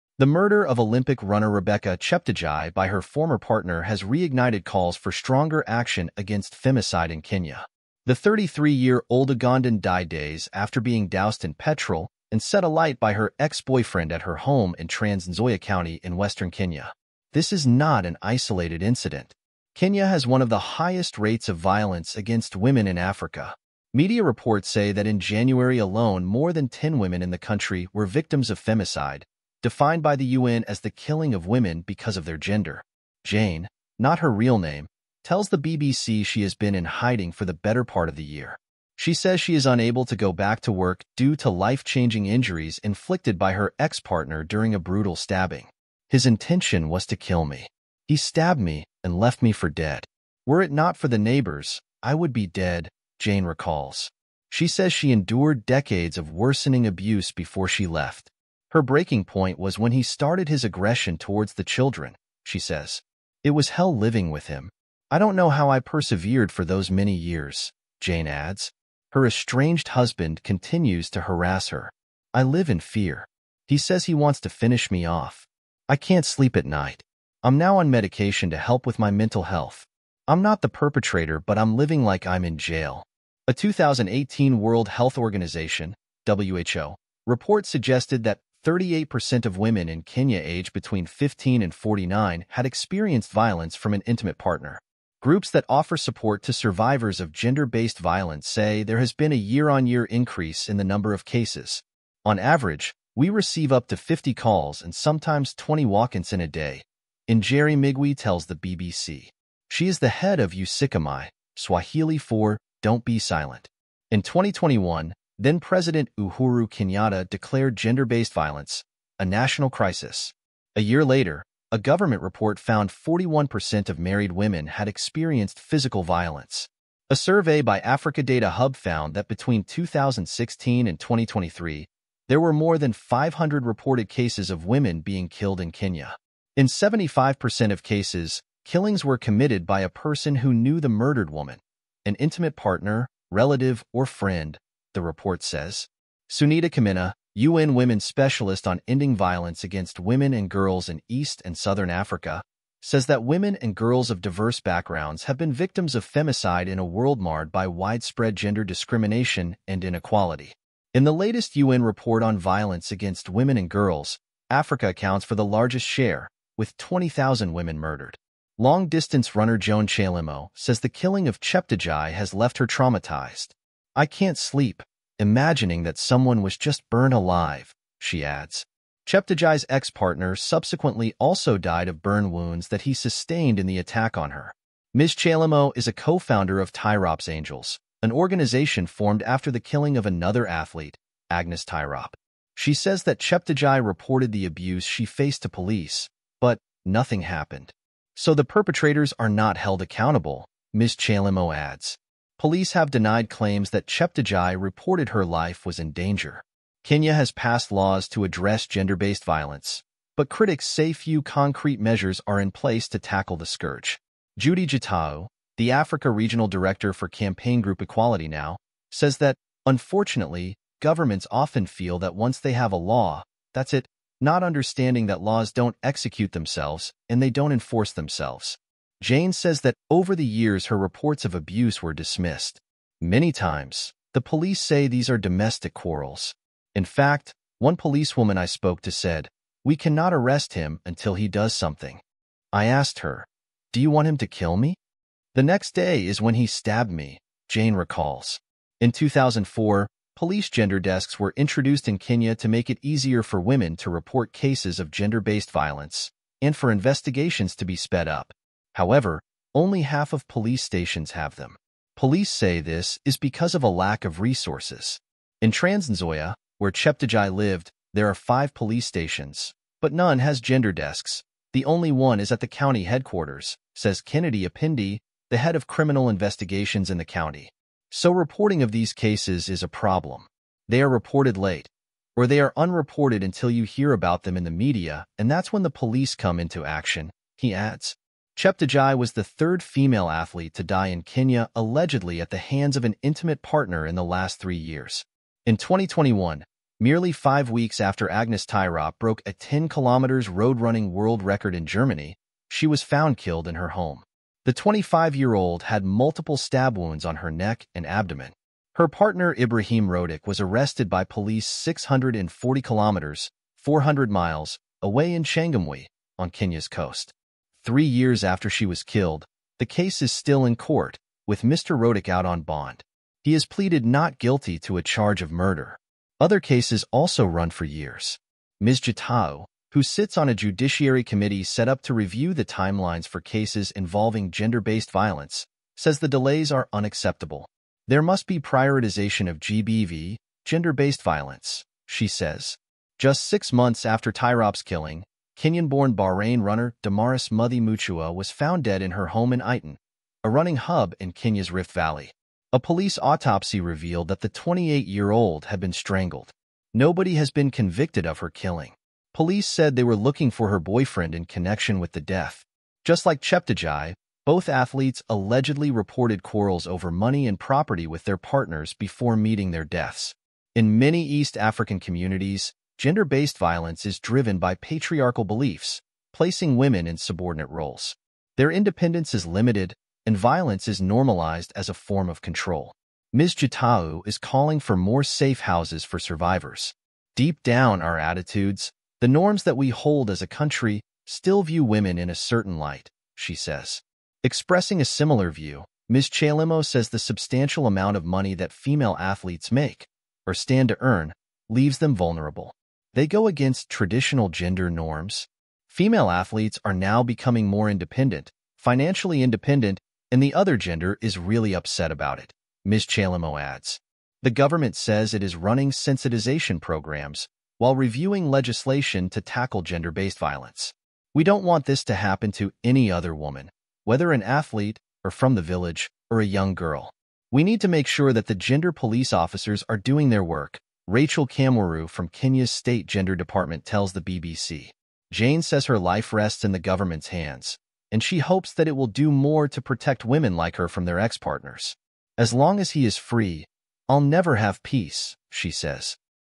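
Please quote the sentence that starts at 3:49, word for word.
Jane says that over the years her reports of abuse were dismissed.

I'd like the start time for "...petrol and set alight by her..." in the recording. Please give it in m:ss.
0:11.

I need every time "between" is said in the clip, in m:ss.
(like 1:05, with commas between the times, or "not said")
1:30, 2:09.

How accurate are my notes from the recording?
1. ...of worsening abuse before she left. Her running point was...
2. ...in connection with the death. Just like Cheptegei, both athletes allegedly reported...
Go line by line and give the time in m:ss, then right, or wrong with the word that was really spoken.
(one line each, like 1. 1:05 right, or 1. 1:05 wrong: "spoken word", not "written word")
1. 0:56 wrong: "breaking", not "running"
2. 6:01 right.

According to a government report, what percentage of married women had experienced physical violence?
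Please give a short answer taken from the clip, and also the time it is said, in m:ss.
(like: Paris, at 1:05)
41%, at 2:02.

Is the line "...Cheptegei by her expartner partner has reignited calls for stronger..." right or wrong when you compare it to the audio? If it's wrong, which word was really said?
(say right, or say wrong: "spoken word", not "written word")
wrong: "former", not "expartner".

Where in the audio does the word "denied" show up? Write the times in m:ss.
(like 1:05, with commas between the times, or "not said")
3:22.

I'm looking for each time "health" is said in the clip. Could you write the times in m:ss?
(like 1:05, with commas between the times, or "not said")
1:19, 1:24.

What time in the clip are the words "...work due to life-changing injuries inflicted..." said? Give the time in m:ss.
0:40.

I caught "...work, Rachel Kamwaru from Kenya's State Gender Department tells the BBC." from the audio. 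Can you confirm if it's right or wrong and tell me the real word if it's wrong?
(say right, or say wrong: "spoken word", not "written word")
right.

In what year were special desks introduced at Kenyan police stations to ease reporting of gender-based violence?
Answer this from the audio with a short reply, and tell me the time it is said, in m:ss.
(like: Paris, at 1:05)
2004, at 4:08.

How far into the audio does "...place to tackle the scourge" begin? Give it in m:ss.
3:32.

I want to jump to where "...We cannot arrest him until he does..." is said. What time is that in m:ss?
3:59.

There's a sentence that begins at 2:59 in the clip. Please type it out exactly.
Cheptegei's ex-partner subsequently also died of burn wounds that he sustained in the attack on her.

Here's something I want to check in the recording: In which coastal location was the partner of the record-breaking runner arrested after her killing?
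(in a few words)
Changamwe.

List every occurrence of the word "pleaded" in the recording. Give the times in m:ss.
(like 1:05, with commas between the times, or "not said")
5:23.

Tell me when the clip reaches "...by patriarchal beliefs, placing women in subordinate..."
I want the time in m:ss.
6:14.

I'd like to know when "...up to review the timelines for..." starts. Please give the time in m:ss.
5:31.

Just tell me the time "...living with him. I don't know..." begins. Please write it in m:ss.
1:03.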